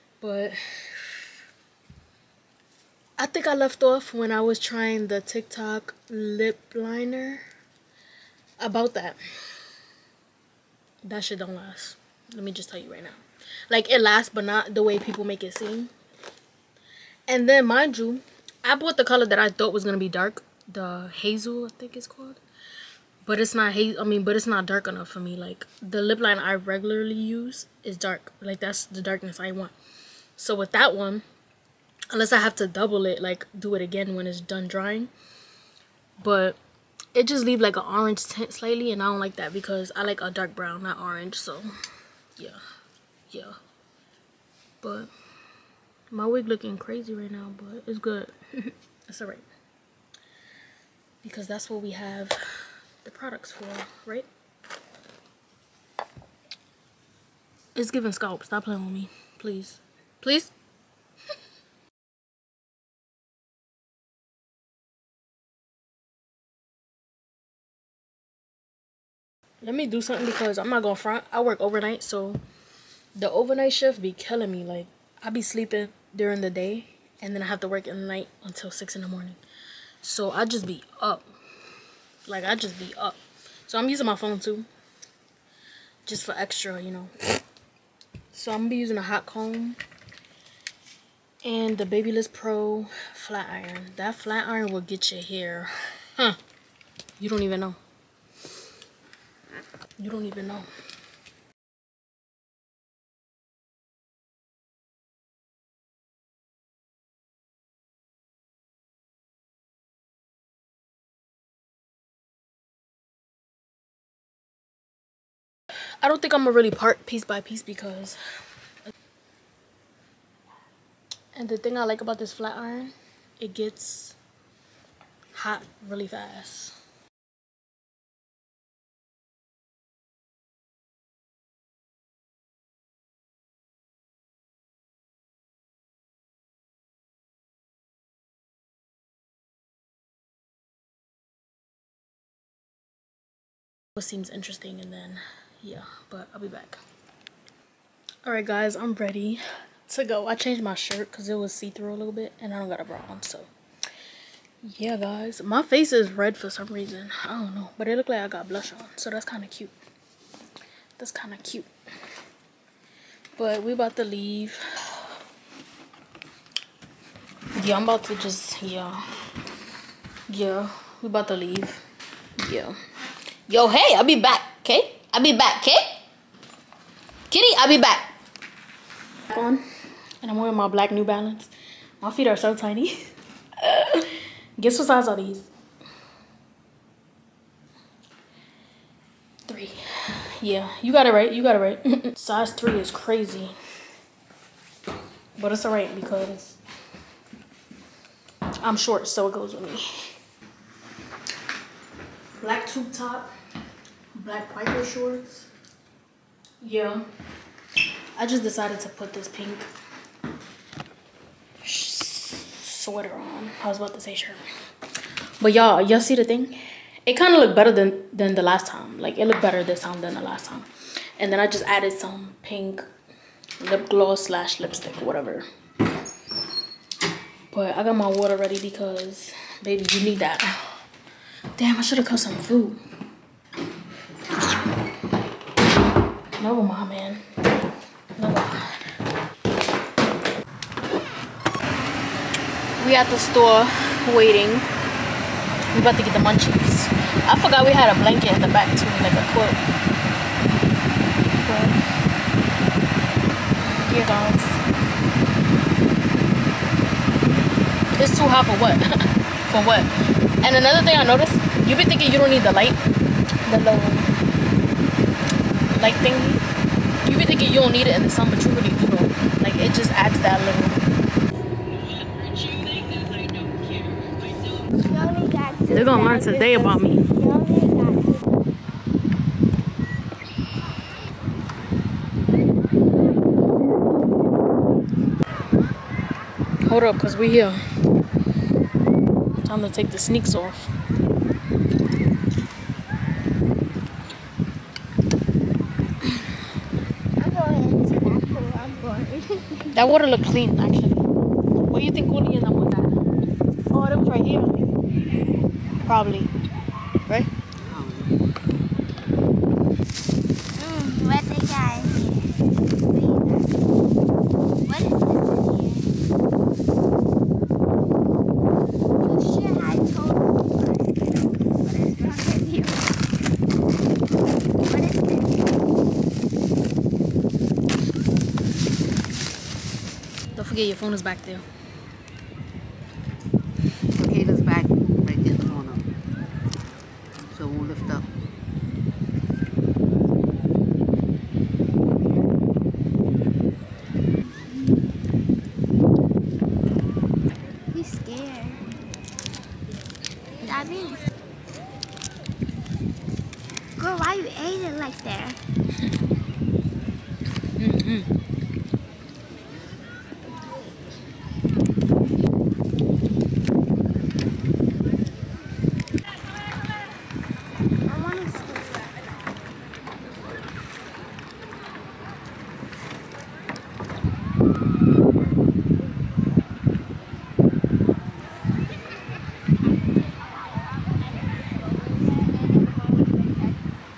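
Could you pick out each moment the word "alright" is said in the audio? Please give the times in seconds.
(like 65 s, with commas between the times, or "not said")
49 s, 195 s.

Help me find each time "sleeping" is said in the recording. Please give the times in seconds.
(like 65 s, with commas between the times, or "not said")
75 s.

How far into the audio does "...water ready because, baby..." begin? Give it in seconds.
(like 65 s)
228 s.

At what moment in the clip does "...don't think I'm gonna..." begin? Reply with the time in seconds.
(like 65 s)
116 s.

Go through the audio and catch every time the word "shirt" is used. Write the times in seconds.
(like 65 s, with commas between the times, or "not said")
150 s, 214 s.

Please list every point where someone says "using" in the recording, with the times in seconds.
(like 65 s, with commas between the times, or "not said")
83 s, 88 s.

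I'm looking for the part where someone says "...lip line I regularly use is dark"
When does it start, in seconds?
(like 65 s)
26 s.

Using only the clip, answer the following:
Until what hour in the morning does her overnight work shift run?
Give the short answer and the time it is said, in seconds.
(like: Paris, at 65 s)
6, at 78 s.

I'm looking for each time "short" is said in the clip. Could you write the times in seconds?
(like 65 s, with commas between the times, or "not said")
198 s, 204 s.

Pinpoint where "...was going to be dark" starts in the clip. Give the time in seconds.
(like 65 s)
19 s.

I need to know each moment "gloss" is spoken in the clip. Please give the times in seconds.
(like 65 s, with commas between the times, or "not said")
223 s.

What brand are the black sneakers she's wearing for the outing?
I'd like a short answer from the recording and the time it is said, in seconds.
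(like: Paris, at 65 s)
New Balance, at 180 s.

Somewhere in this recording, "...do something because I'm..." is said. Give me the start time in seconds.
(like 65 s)
69 s.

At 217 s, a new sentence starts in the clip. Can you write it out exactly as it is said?
It kind of looked better than, than the last time.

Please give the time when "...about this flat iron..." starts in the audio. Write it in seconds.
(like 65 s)
122 s.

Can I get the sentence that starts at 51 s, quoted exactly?
Because that's what we have the products for, right?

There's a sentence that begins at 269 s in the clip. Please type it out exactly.
Like it just adds that little They're gonna learn today about me.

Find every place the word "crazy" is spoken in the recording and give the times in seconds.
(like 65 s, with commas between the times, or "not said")
46 s, 192 s.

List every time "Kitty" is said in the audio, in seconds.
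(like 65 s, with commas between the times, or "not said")
177 s.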